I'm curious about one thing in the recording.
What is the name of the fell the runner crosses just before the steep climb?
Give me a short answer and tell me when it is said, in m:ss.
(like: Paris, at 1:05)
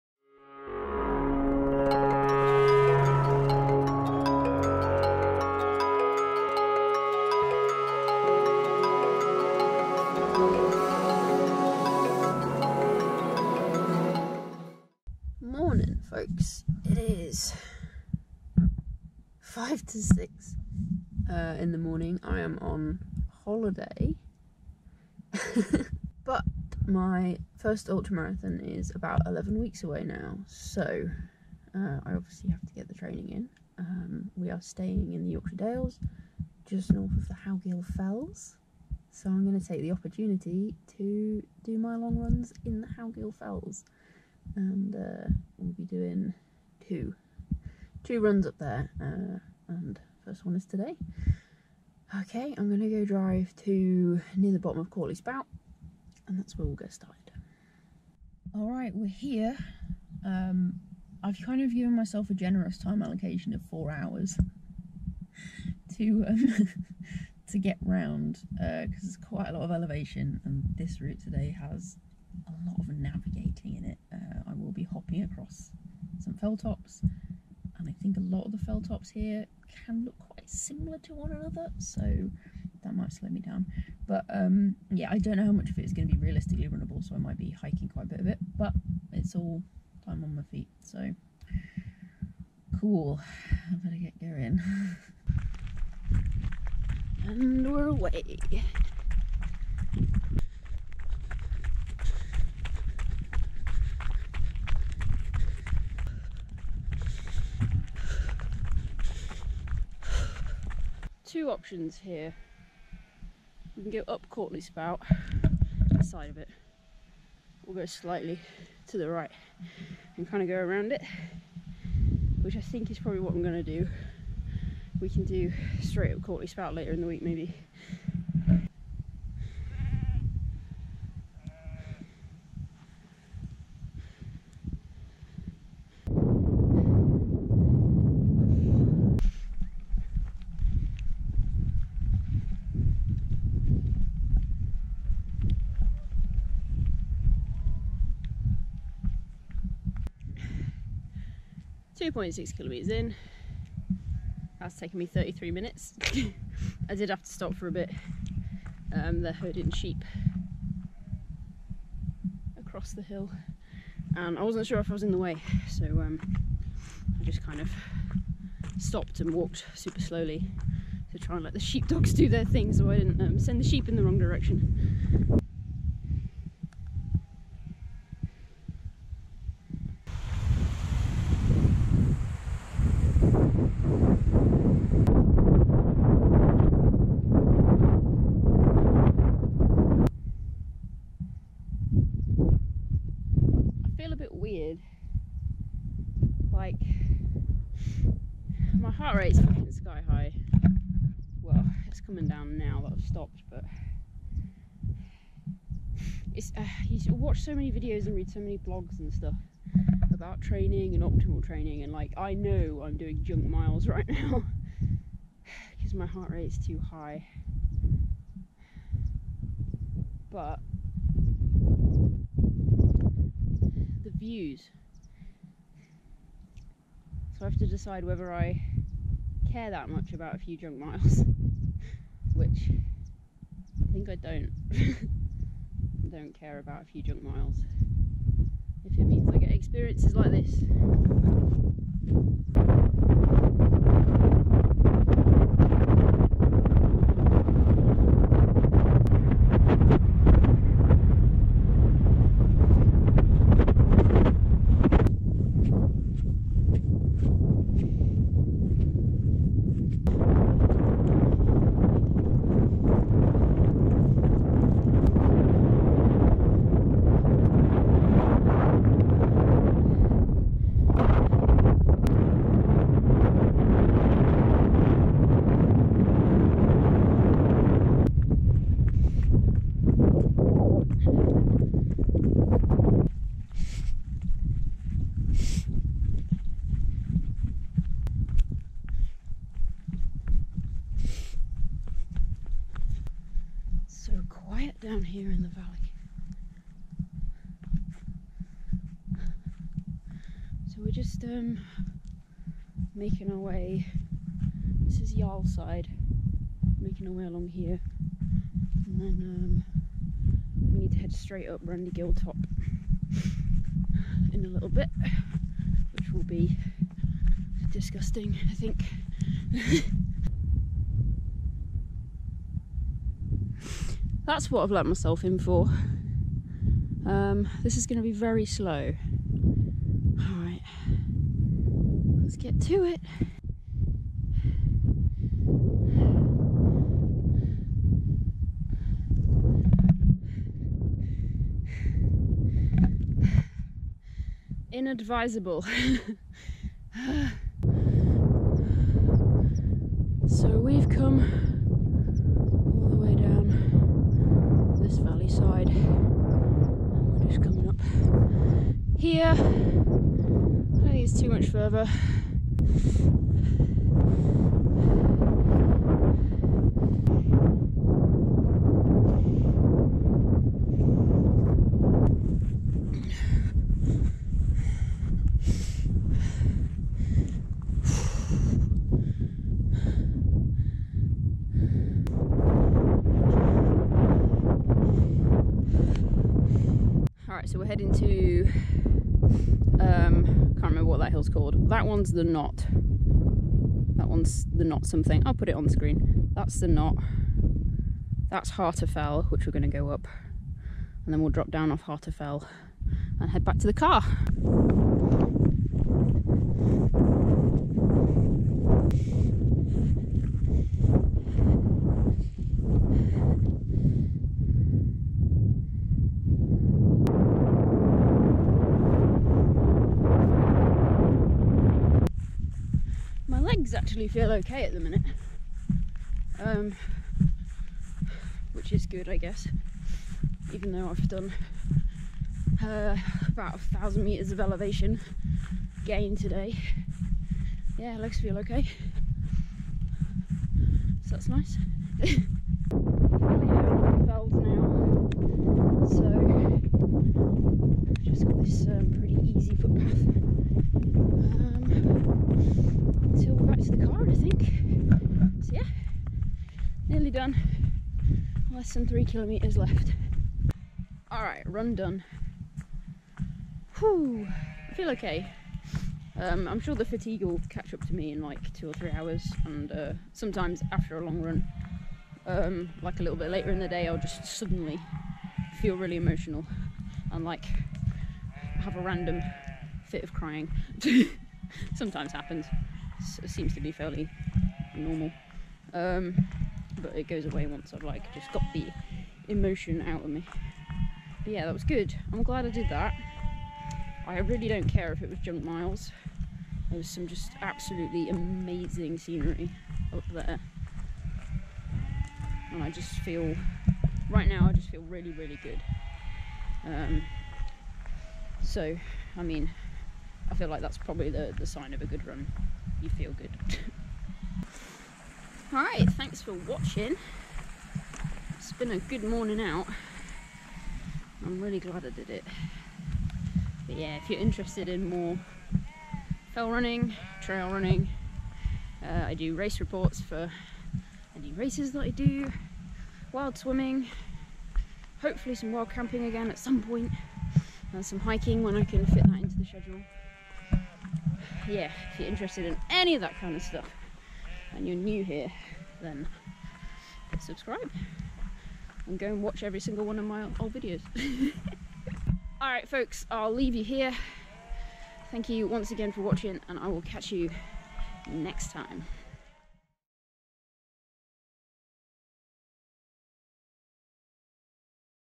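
Yarlside, at 5:05.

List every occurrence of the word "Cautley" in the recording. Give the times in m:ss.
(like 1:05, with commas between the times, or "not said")
0:54, 1:54, 2:06.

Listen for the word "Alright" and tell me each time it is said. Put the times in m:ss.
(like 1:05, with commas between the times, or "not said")
8:35.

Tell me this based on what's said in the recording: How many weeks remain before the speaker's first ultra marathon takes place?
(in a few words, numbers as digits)
11.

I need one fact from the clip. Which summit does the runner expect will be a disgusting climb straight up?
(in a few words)
Randygill Top.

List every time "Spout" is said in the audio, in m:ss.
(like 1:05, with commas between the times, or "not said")
0:55, 1:54, 2:06.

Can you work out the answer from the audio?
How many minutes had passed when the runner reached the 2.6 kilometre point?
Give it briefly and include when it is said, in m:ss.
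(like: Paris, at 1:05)
33, at 2:35.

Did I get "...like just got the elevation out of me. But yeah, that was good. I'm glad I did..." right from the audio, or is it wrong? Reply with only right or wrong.
wrong.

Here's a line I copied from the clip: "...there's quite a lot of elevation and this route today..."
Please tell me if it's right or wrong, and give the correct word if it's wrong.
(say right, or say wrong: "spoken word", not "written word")
right.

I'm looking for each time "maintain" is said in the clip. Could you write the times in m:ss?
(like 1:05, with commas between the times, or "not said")
not said.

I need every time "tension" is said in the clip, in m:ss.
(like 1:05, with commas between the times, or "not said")
not said.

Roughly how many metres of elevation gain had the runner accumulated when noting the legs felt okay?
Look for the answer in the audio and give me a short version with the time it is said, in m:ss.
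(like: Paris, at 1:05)
1000, at 7:13.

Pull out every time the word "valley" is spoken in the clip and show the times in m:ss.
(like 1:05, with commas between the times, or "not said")
5:54.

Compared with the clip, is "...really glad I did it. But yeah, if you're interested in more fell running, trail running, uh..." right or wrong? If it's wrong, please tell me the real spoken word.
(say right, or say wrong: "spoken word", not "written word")
right.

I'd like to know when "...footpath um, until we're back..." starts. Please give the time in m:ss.
7:29.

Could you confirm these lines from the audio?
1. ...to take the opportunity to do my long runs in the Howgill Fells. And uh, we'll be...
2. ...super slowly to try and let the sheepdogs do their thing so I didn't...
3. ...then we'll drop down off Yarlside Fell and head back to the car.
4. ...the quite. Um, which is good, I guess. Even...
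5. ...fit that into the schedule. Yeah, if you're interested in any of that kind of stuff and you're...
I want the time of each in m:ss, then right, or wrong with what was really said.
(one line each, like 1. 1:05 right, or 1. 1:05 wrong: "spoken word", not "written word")
1. 0:39 right
2. 2:49 right
3. 6:41 wrong: "Harter", not "Yarlside"
4. 7:04 wrong: "minute", not "quite"
5. 8:58 right.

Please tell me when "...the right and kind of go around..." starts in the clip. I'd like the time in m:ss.
1:58.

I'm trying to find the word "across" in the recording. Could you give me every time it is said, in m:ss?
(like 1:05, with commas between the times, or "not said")
1:15, 2:42.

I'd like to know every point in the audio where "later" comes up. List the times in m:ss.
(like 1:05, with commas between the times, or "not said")
2:06, 7:53.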